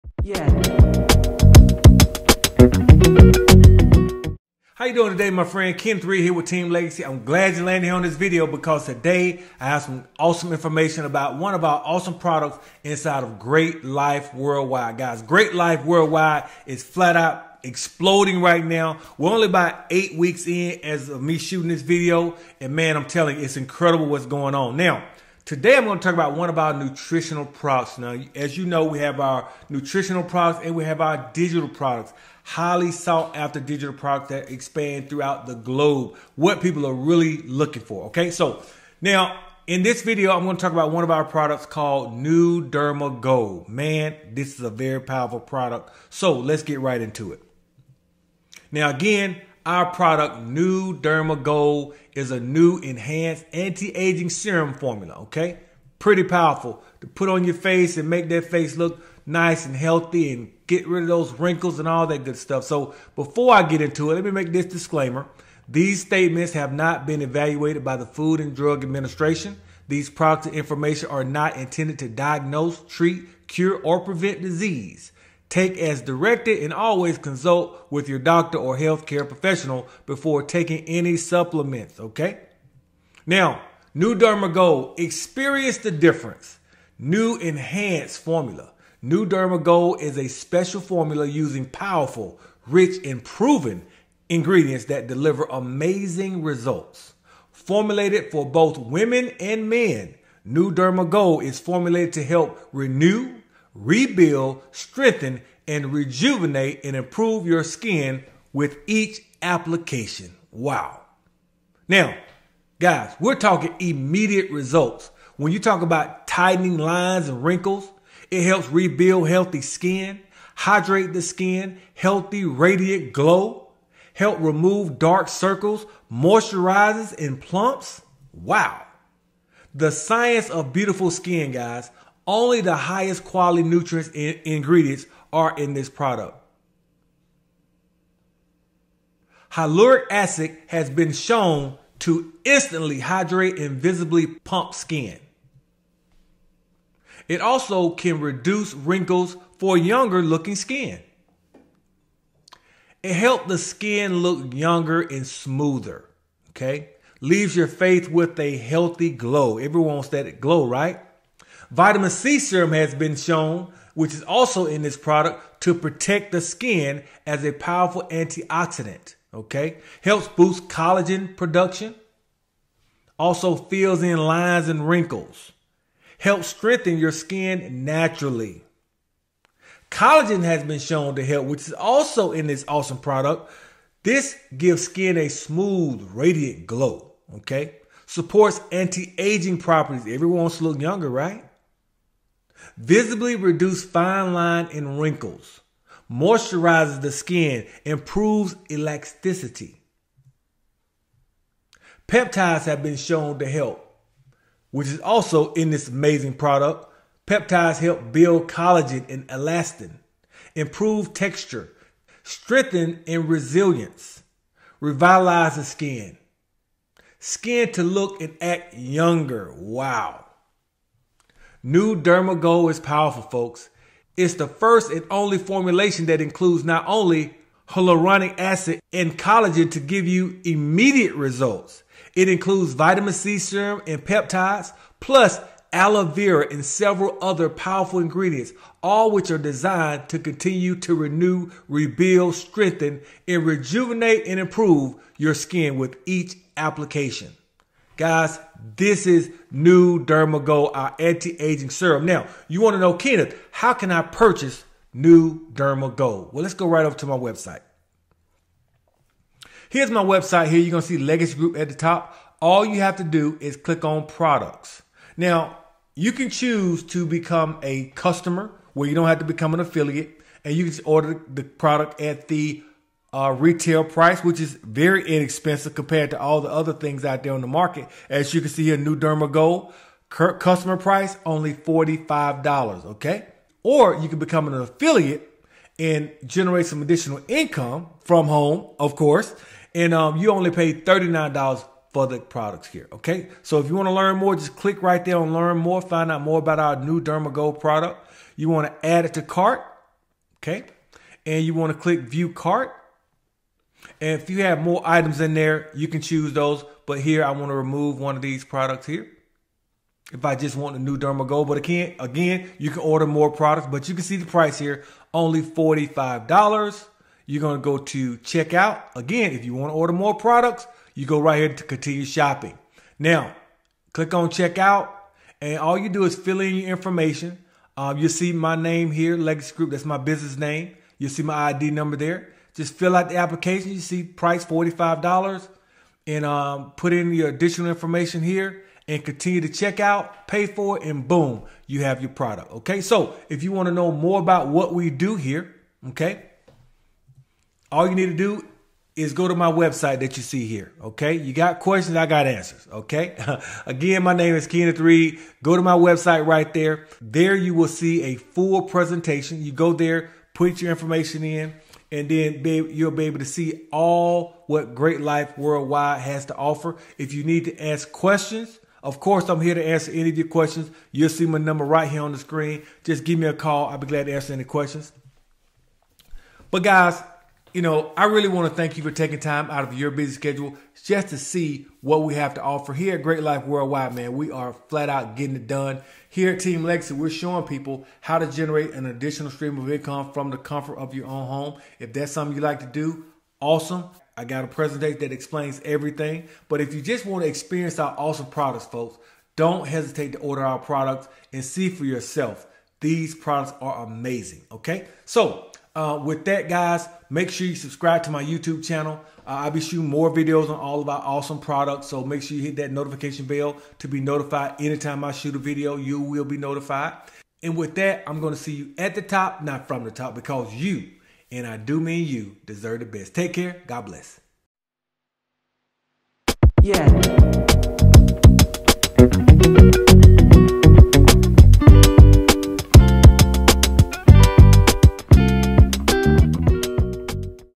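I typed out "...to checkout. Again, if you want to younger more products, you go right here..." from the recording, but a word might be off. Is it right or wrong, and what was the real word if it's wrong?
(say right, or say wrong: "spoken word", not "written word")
wrong: "order", not "younger".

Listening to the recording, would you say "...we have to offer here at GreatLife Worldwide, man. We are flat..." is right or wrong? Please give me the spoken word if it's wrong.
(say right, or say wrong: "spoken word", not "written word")
right.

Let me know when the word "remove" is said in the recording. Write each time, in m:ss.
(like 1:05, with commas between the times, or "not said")
2:04, 5:07.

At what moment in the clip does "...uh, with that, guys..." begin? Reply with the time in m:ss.
6:45.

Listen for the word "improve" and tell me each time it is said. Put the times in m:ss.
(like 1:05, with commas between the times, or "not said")
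1:46, 3:17, 3:30, 4:04.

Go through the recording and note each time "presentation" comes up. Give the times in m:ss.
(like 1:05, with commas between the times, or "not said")
5:58, 6:34.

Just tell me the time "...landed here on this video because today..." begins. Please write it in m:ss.
0:07.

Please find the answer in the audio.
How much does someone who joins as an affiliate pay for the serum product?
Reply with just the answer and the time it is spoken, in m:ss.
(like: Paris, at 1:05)
$39, at 4:50.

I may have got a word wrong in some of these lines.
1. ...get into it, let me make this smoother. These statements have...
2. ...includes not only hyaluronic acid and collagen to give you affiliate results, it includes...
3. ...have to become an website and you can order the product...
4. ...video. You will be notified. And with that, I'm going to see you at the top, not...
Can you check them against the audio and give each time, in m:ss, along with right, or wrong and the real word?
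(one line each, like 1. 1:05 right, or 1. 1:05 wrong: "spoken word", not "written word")
1. 1:03 wrong: "disclaimer", not "smoother"
2. 3:46 wrong: "immediate", not "affiliate"
3. 4:29 wrong: "affiliate", not "website"
4. 6:55 right.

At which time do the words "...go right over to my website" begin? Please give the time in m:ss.
4:16.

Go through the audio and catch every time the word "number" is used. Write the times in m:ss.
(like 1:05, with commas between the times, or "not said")
5:31, 6:11.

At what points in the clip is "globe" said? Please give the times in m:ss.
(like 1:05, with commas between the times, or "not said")
0:35.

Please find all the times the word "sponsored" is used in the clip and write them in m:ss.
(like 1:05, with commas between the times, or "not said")
not said.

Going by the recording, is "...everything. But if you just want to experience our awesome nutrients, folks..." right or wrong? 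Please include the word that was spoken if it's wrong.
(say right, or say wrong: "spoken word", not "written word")
wrong: "products", not "nutrients".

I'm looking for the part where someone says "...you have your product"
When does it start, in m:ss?
5:41.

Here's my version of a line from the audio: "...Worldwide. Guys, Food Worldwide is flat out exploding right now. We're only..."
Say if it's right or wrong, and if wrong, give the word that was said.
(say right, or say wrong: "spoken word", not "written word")
wrong: "GreatLife", not "Food".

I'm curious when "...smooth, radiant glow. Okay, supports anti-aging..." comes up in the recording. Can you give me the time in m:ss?
3:05.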